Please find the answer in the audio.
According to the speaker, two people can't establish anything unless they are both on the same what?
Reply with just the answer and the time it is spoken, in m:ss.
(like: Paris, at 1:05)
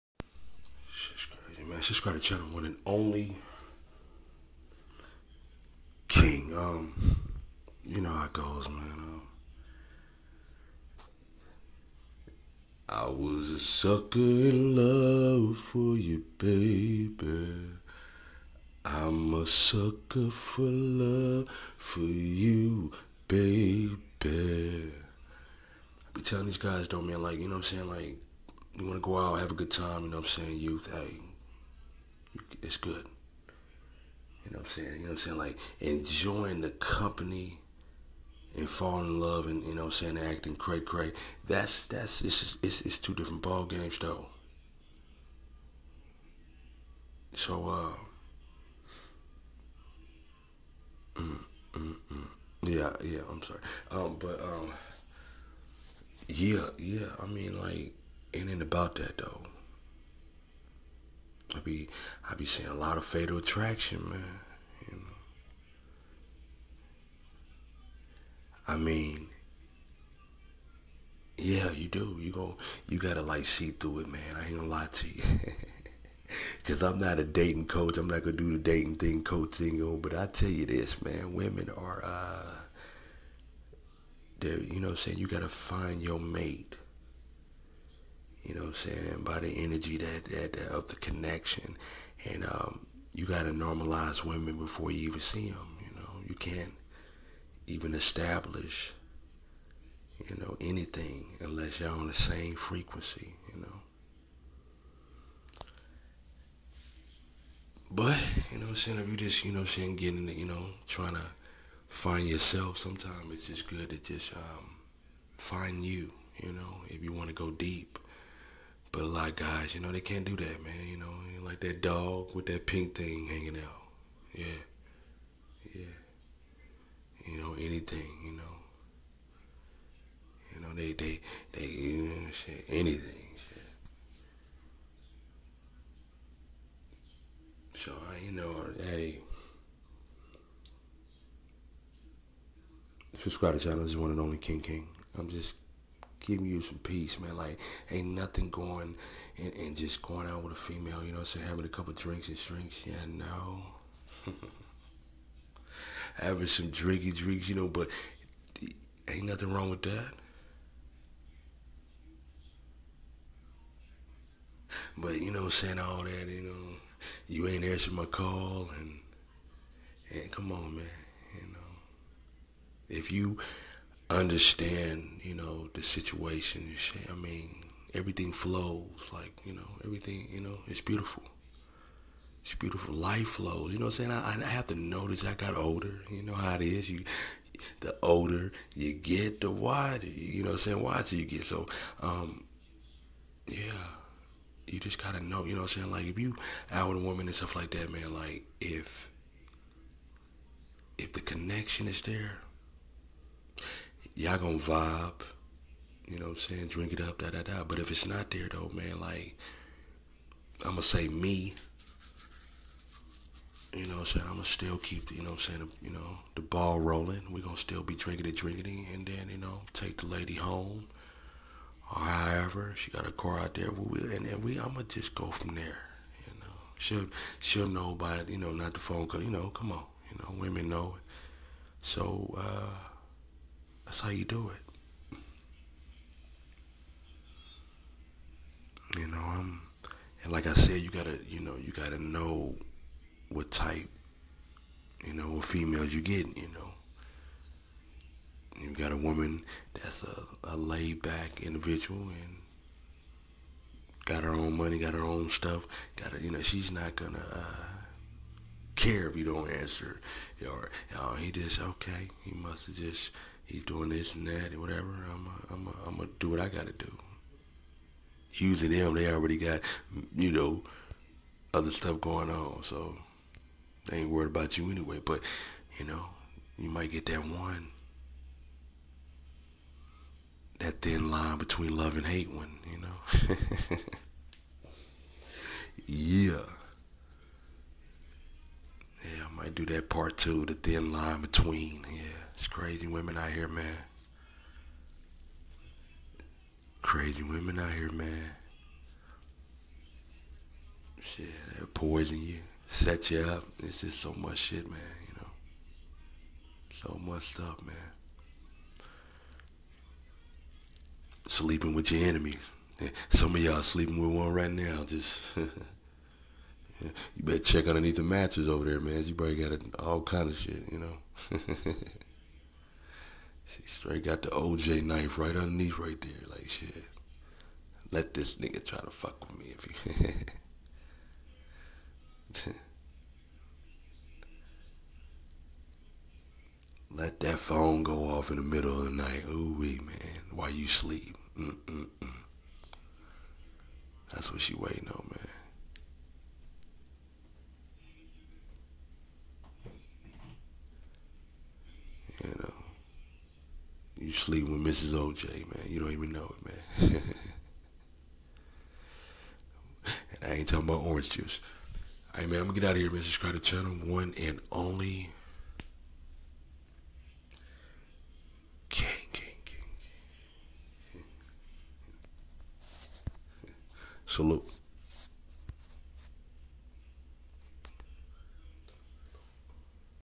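Frequency, at 1:42.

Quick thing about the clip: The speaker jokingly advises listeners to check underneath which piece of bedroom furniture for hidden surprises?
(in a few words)
The mattress.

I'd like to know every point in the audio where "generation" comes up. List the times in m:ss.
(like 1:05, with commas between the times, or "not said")
not said.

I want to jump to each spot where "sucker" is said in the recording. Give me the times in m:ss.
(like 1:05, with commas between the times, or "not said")
0:13, 0:19.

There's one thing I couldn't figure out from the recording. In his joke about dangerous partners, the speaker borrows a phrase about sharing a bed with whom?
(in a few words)
Your enemies.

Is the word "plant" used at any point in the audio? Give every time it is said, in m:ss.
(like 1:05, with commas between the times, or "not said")
not said.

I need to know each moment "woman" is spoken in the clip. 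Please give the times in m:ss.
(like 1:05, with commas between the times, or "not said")
3:17, 4:08.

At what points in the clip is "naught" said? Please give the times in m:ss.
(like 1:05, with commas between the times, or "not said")
not said.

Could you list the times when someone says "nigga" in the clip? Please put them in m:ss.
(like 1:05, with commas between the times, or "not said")
5:28.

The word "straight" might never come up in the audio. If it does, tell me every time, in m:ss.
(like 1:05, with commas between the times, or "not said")
5:23.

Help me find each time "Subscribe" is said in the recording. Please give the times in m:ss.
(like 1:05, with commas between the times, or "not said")
0:01, 2:23, 6:03.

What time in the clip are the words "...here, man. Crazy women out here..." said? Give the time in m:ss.
4:53.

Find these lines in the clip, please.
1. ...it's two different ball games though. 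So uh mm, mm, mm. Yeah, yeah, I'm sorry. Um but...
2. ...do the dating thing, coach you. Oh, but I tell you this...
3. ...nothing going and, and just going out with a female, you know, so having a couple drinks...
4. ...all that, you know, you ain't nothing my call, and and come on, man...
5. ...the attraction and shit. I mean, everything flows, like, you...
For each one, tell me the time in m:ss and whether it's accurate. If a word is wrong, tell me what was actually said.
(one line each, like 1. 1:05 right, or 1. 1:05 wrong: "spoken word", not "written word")
1. 0:42 right
2. 1:18 right
3. 2:28 right
4. 2:45 wrong: "answering", not "nothing"
5. 2:55 wrong: "situation", not "attraction".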